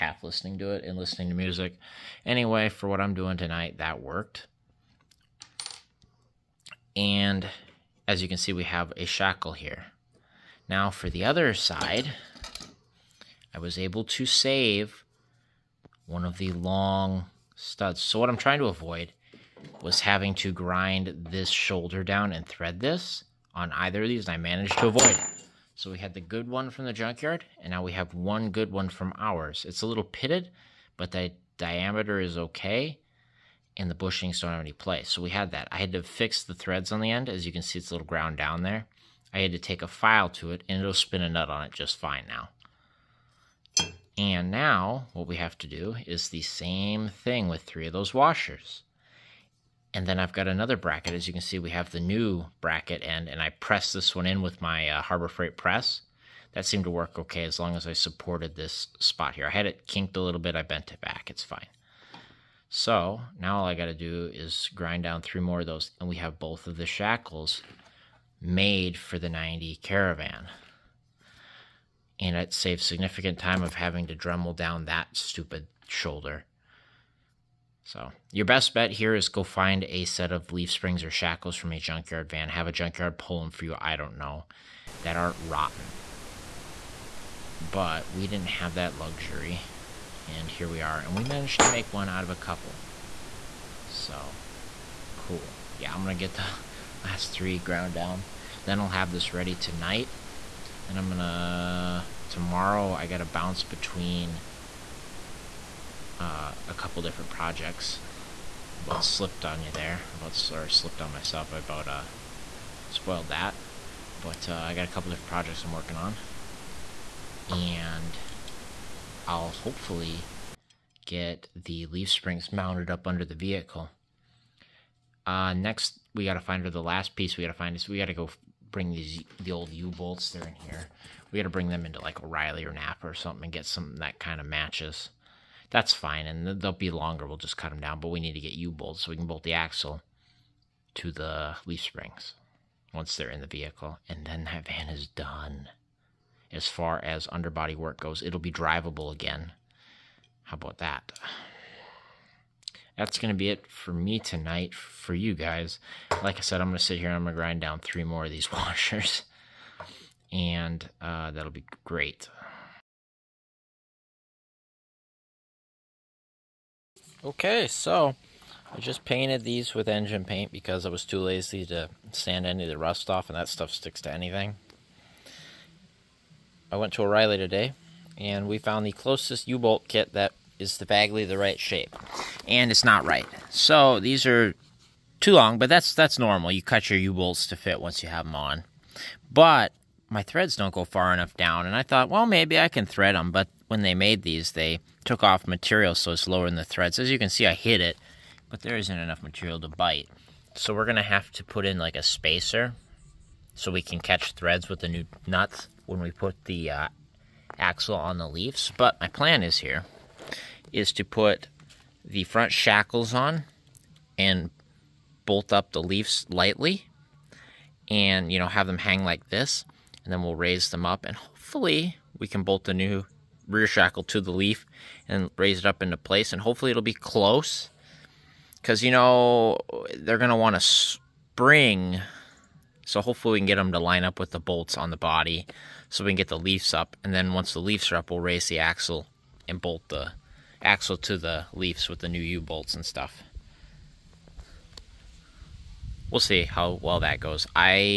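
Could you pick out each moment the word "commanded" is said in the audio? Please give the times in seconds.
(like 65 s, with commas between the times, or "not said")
not said.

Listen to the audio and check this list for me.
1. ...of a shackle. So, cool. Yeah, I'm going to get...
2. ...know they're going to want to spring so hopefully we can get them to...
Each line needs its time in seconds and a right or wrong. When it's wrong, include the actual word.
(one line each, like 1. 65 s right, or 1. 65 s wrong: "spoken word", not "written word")
1. 92 s wrong: "couple", not "shackle"
2. 228 s right.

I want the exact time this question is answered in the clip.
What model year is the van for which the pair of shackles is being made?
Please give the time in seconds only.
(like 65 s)
69 s.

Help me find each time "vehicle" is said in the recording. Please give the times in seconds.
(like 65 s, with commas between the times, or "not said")
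123 s, 143 s.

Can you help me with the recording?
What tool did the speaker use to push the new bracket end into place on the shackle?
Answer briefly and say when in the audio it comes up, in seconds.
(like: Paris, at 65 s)
Harbor Freight press, at 55 s.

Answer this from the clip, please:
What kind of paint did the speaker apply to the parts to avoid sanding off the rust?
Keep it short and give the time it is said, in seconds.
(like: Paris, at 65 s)
Engine paint, at 169 s.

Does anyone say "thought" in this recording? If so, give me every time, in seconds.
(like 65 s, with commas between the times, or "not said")
191 s.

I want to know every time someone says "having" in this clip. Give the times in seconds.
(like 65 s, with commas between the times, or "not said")
19 s, 73 s.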